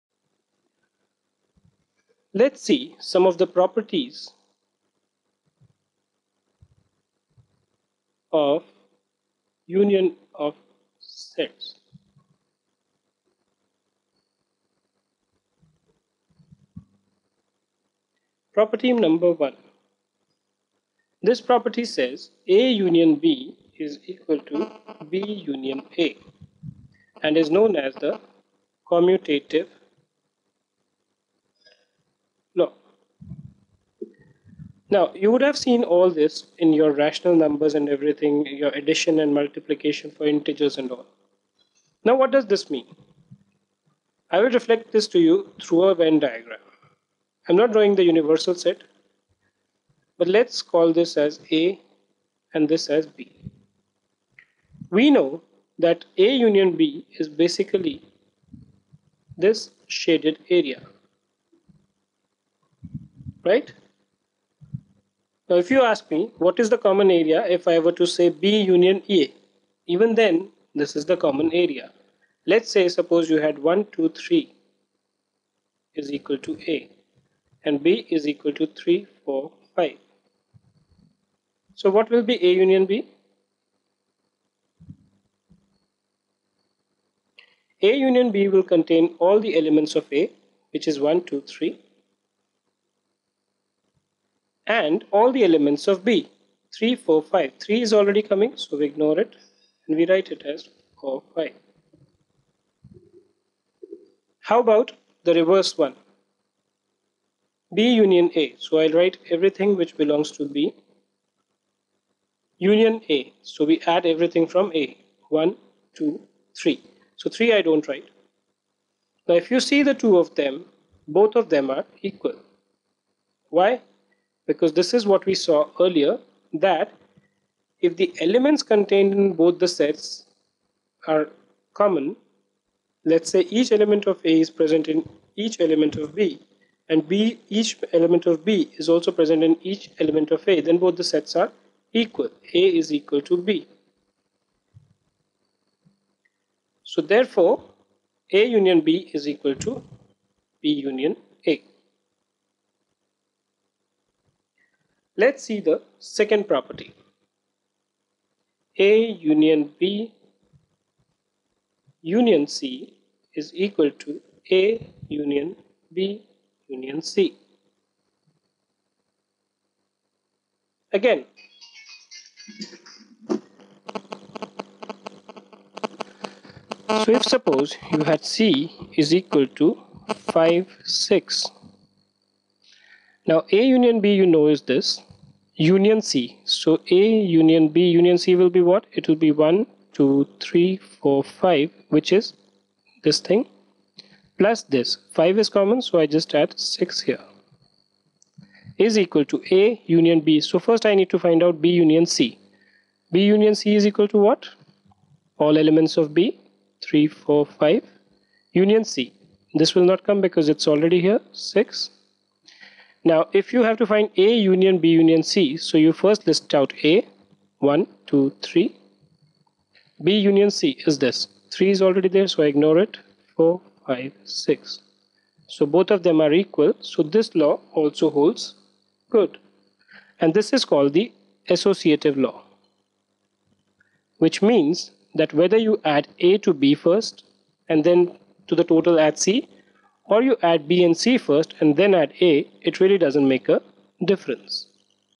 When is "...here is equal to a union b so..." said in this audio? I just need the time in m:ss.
3:17.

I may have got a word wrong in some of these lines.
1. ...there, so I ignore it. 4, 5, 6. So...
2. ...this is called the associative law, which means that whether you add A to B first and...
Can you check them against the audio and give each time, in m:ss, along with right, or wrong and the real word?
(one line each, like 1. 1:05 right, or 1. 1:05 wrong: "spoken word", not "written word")
1. 3:42 right
2. 3:50 right.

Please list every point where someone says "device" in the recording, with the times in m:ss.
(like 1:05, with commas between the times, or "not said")
not said.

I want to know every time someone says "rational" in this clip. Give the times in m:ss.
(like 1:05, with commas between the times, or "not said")
0:36.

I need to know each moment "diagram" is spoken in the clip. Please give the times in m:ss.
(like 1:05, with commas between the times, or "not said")
0:46.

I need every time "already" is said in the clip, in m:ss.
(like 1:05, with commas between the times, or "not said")
1:37, 3:30, 3:41.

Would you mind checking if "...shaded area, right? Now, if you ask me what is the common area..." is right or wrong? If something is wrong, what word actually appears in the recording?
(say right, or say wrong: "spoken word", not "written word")
right.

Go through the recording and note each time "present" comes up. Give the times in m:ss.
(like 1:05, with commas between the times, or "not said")
2:14, 2:19.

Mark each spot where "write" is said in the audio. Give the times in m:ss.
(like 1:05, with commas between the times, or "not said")
1:40, 1:48, 1:57.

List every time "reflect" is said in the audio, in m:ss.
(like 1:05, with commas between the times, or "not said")
0:44.